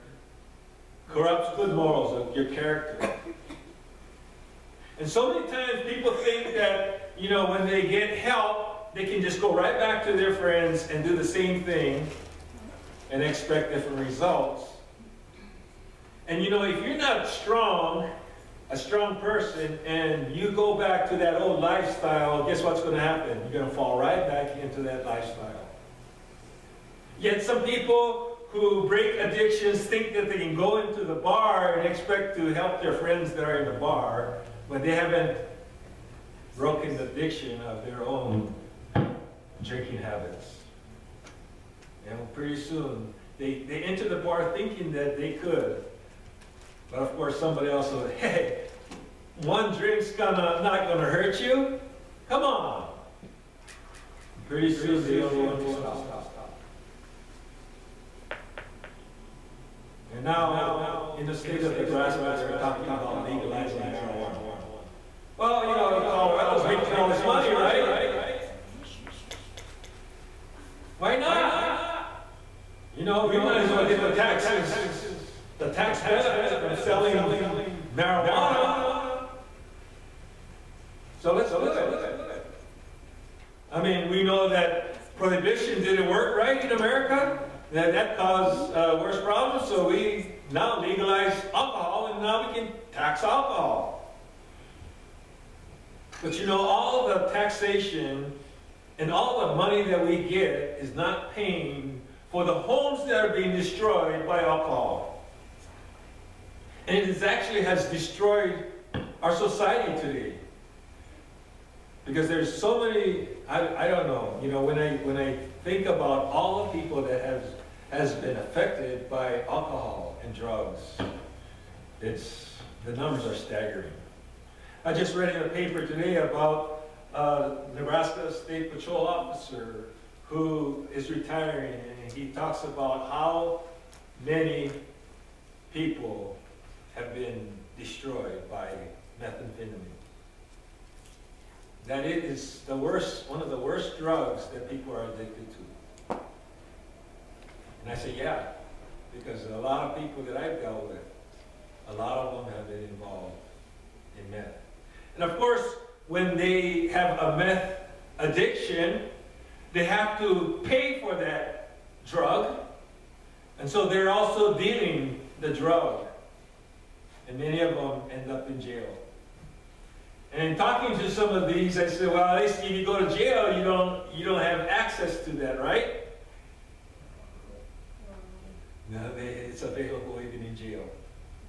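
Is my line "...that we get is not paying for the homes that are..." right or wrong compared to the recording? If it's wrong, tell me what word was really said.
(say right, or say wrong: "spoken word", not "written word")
right.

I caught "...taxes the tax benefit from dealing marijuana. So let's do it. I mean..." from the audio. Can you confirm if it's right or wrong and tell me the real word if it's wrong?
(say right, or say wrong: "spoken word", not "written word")
wrong: "selling", not "dealing".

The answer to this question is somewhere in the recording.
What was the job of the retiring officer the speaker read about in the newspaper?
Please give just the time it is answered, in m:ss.
2:07.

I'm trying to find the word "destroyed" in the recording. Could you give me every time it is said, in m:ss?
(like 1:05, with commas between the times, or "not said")
1:43, 1:47.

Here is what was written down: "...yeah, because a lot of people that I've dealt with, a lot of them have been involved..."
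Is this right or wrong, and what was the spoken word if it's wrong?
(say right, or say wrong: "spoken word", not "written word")
right.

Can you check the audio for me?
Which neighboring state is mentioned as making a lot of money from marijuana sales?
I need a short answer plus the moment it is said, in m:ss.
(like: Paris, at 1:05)
Colorado, at 1:06.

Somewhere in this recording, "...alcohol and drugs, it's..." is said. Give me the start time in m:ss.
1:59.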